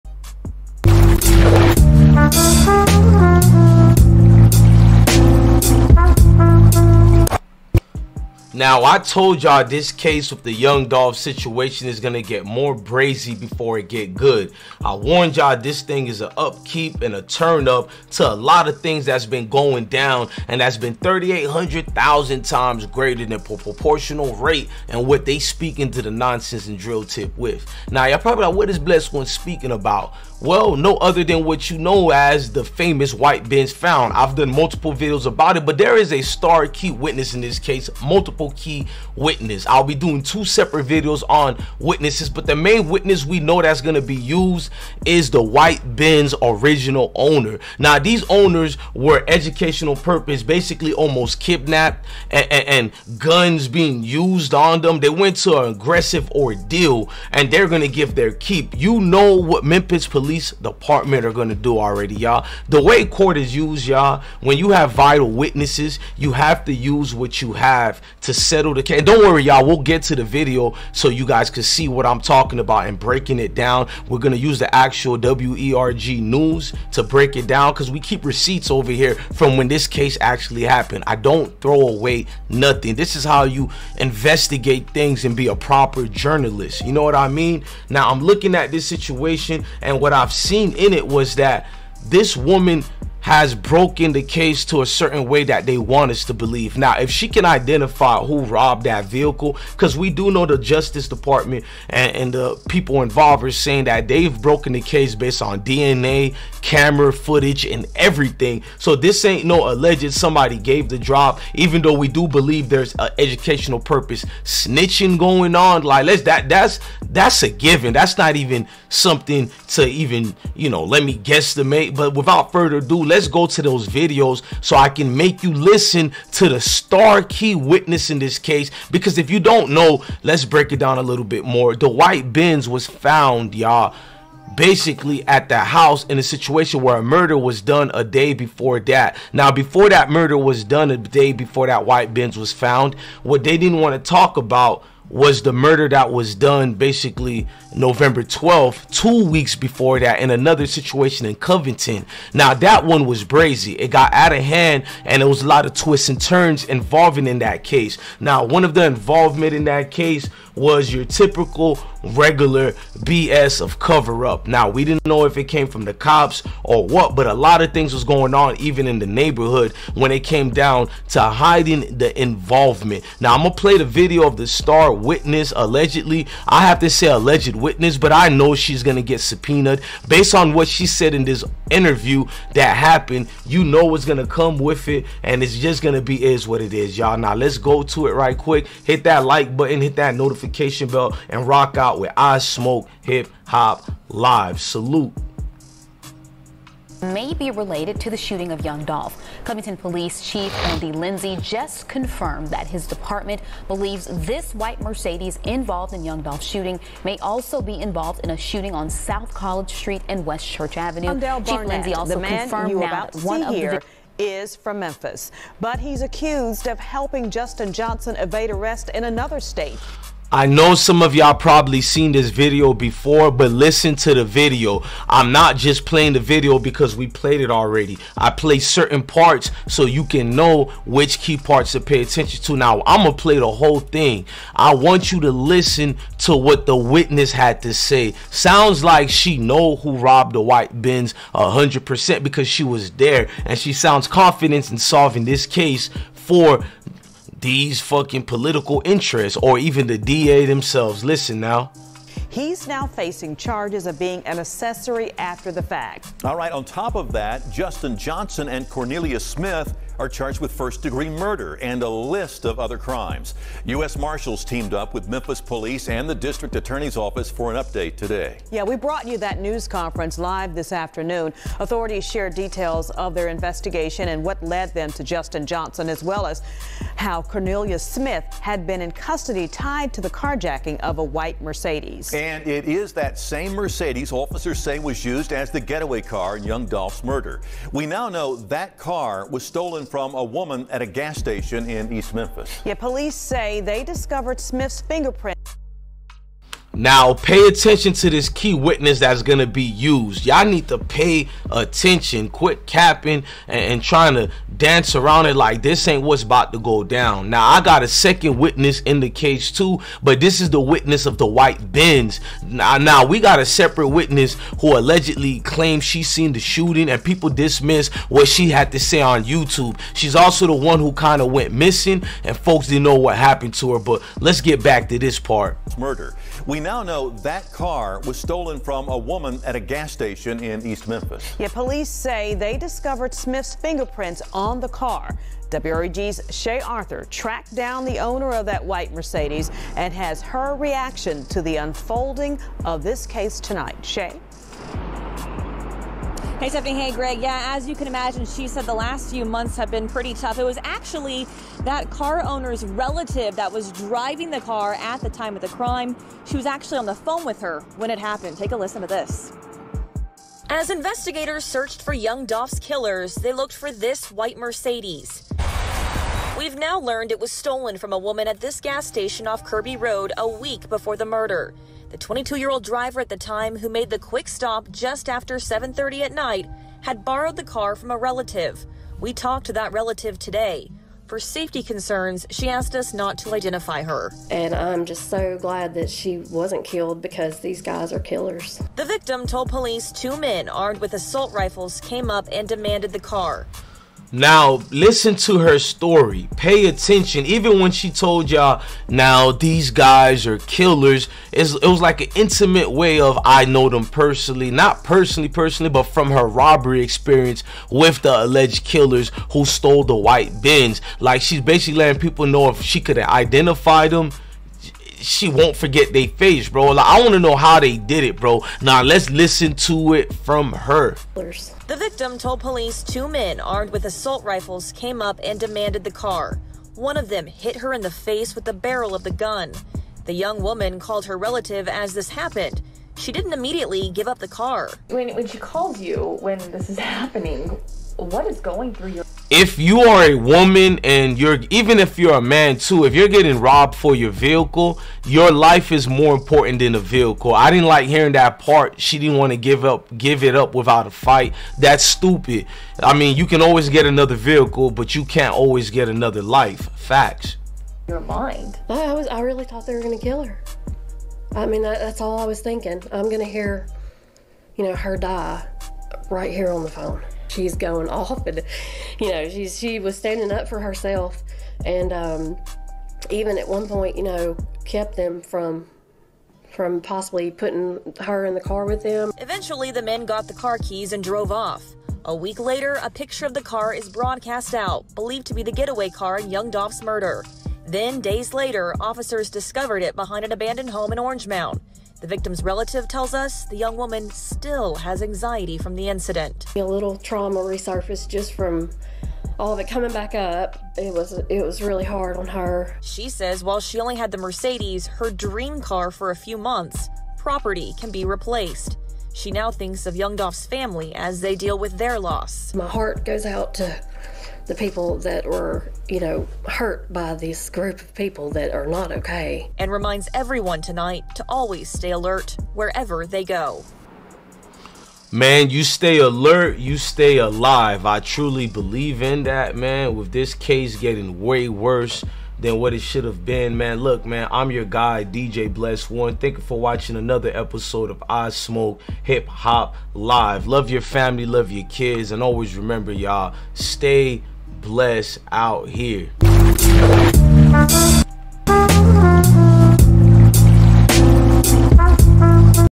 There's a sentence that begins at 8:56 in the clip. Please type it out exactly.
Thank you for watching another episode of I Smoke Hip Hop Live.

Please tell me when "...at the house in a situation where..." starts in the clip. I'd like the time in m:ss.
2:15.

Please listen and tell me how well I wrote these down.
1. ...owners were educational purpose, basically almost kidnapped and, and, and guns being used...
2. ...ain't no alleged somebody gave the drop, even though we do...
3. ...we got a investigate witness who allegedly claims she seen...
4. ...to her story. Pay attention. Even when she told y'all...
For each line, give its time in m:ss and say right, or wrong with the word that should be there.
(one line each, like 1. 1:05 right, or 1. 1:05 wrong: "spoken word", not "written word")
1. 0:48 right
2. 1:49 right
3. 5:13 wrong: "separate", not "investigate"
4. 6:35 right.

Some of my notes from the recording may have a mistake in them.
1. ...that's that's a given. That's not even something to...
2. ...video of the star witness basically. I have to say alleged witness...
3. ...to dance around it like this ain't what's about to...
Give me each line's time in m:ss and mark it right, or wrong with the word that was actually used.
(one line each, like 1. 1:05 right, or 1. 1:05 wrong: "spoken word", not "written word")
1. 1:56 right
2. 2:53 wrong: "allegedly", not "basically"
3. 5:04 right.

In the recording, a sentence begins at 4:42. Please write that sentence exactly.
And and it is that same Mercedes officers say was used as the getaway car in young Dolph's murder.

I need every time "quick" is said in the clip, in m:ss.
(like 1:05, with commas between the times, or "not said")
3:08, 6:13.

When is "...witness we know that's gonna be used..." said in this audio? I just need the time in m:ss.
0:42.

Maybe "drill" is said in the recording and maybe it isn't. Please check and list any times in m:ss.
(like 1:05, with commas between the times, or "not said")
0:26.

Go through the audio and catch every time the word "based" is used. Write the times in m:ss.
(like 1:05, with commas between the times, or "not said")
1:45, 3:00.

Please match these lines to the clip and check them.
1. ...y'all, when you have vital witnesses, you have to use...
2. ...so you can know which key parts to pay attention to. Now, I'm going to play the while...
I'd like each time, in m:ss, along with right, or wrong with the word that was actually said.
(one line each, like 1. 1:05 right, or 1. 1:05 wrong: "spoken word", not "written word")
1. 1:03 right
2. 3:49 wrong: "whole", not "while".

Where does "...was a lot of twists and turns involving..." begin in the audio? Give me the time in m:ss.
2:35.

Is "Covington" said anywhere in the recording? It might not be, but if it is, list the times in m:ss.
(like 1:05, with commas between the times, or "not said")
2:31, 3:19.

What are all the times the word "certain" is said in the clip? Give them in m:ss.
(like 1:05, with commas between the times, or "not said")
1:34, 3:48.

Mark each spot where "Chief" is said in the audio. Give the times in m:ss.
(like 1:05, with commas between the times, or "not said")
3:20, 3:31.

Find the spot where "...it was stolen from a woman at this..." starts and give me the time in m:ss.
6:07.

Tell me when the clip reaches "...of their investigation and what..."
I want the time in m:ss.
4:32.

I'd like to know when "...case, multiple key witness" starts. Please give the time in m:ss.
0:37.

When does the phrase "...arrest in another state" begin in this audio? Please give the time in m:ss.
3:38.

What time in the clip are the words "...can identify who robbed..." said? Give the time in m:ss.
1:37.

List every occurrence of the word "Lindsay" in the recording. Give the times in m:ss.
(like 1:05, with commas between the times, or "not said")
3:20, 3:31.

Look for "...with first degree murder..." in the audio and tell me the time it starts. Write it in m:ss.
4:20.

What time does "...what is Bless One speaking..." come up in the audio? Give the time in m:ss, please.
0:28.